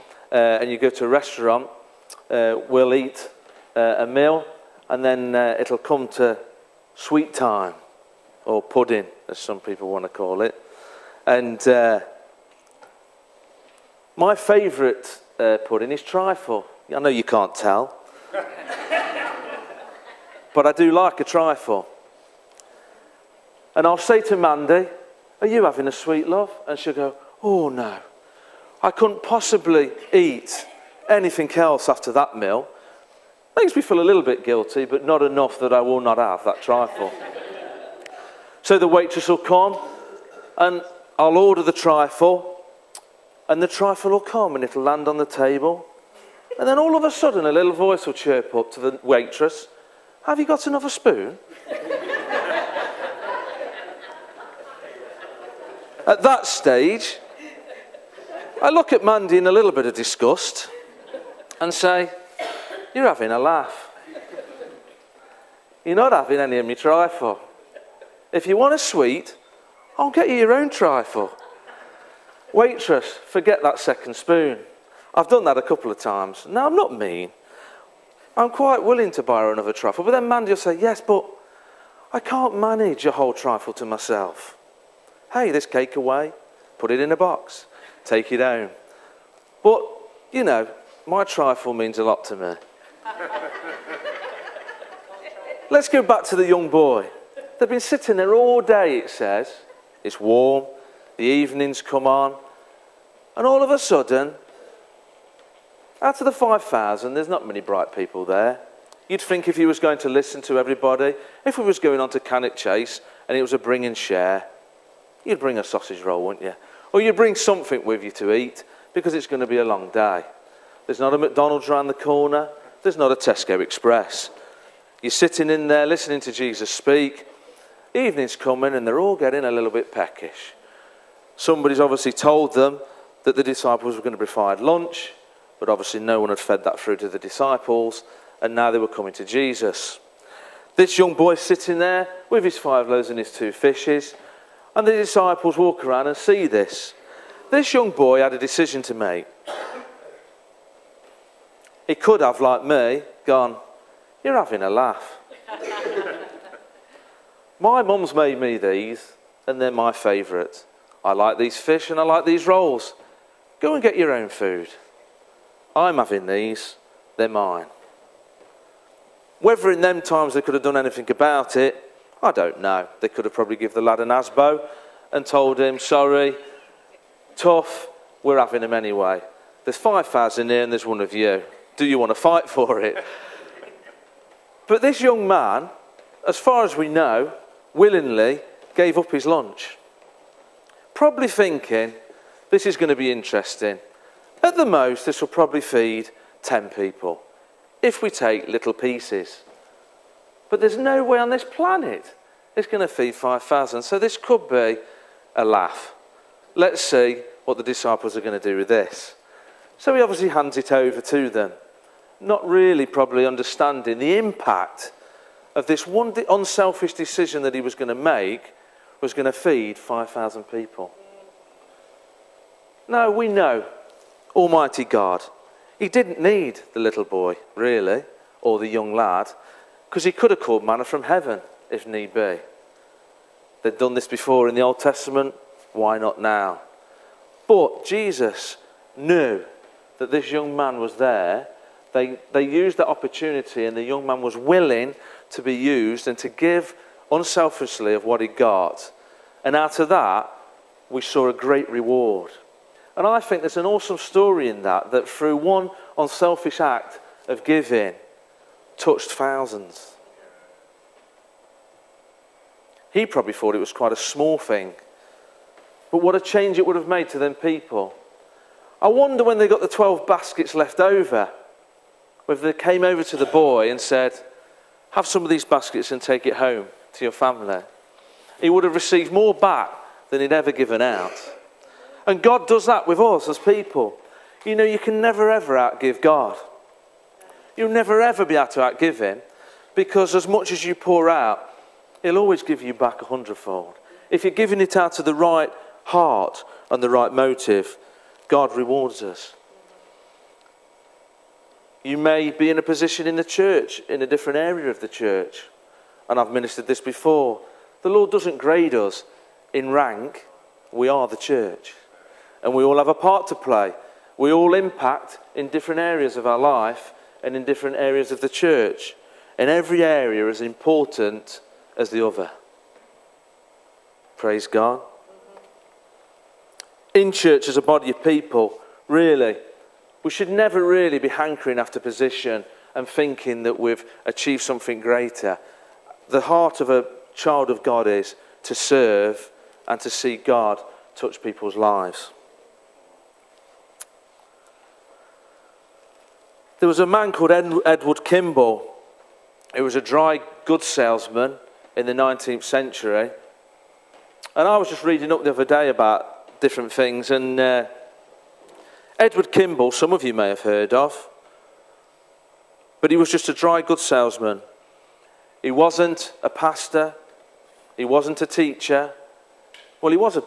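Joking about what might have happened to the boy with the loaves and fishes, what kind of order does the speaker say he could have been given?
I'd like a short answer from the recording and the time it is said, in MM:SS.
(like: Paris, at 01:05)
An ASBO, at 02:54.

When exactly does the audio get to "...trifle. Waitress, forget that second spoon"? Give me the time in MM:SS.
01:10.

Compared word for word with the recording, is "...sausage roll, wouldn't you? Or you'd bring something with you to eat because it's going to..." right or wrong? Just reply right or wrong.
right.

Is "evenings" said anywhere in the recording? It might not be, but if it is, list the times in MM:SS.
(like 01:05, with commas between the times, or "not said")
01:41, 02:07.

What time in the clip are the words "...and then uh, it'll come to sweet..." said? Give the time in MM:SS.
00:04.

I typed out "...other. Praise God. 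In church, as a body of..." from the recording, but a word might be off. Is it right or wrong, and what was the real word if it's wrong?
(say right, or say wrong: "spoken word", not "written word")
right.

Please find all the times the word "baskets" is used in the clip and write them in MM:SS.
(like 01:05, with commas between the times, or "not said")
04:30, 04:35.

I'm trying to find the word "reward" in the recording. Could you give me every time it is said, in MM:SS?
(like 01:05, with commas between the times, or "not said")
04:11, 04:58.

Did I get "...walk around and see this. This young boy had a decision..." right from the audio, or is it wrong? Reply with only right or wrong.
right.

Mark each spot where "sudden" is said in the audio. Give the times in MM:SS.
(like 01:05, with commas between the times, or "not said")
00:47, 01:43.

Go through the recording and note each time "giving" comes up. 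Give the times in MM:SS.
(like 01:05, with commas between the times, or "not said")
04:17, 04:54.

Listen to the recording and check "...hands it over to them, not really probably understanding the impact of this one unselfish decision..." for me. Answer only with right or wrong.
right.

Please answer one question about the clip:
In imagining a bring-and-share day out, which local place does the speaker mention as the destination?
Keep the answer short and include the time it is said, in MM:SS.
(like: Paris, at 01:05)
Cannock Chase, at 01:52.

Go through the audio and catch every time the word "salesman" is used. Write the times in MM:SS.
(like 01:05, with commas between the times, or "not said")
05:50, 06:03.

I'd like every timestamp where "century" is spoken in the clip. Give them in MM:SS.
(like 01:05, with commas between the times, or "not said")
05:52.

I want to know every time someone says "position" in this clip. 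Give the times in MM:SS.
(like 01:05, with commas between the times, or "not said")
05:02, 05:31.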